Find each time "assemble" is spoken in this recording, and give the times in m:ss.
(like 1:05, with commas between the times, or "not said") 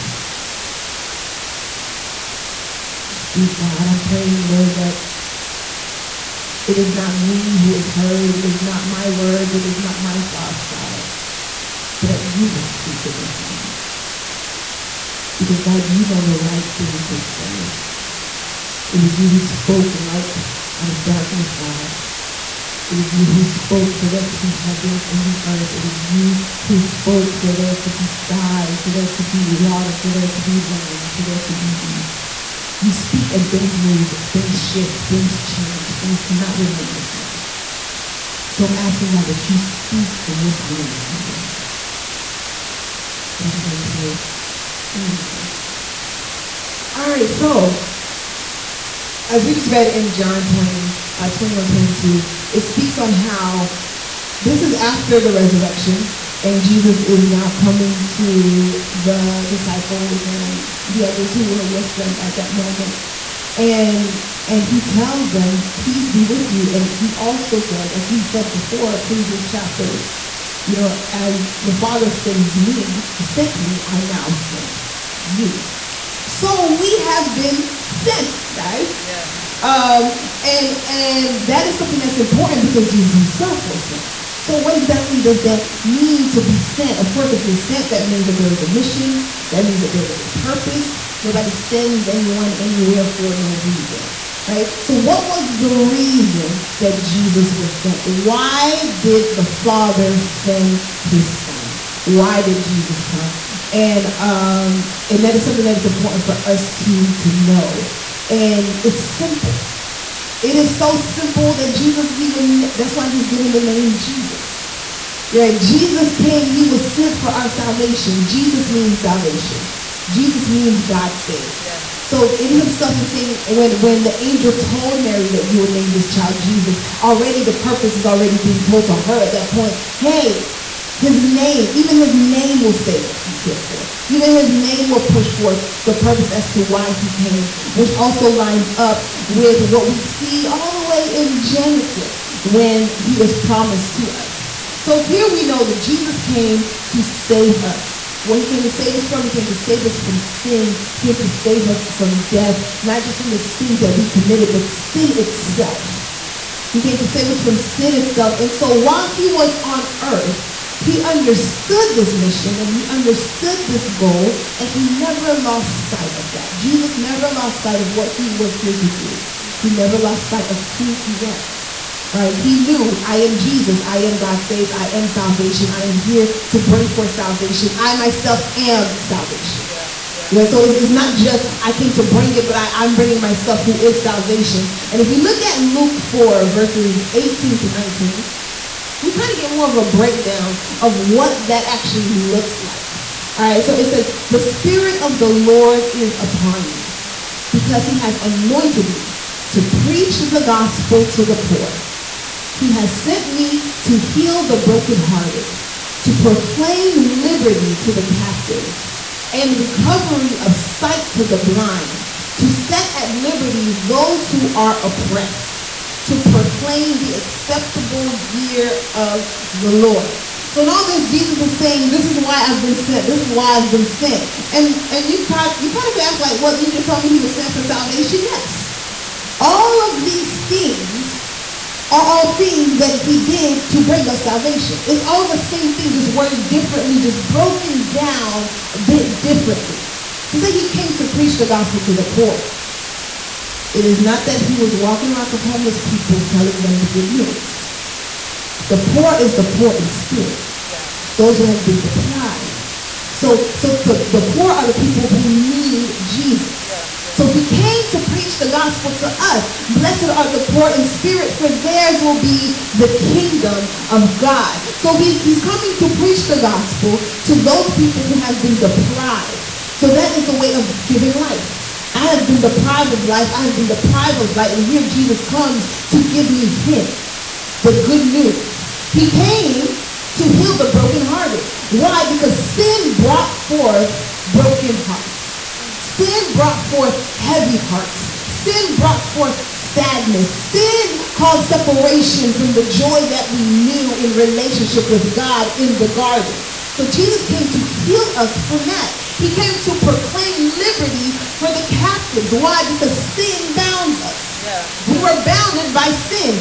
not said.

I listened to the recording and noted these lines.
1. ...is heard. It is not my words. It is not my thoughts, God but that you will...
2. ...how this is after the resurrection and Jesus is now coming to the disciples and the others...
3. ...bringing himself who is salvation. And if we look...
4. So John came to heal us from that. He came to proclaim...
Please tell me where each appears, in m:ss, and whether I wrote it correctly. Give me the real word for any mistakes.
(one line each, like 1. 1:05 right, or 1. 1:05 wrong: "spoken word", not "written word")
1. 0:07 right
2. 0:53 right
3. 3:02 wrong: "myself", not "himself"
4. 4:56 wrong: "Jesus", not "John".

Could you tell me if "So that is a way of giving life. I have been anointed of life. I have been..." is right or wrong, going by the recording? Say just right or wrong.
wrong.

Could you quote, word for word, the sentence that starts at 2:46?
Jesus never lost sight of what he was here to do, he never lost sight of who he was.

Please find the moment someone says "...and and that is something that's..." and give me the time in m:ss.
1:20.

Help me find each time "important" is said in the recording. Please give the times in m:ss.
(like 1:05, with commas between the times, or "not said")
1:22, 1:45.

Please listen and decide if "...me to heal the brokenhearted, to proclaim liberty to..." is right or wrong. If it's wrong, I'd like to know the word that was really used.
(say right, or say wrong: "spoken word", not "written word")
right.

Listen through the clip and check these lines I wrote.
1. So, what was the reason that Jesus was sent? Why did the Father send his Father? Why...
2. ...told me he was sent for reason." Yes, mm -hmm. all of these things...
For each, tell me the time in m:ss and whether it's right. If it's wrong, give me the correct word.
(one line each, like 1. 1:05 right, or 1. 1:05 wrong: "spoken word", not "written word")
1. 1:34 wrong: "Son", not "Father"
2. 3:46 wrong: "salvation", not "reason".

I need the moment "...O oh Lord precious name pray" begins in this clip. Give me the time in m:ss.
0:41.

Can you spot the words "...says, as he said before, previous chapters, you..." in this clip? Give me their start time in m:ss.
1:07.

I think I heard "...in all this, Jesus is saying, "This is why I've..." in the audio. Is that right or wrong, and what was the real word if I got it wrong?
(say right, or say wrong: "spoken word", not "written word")
right.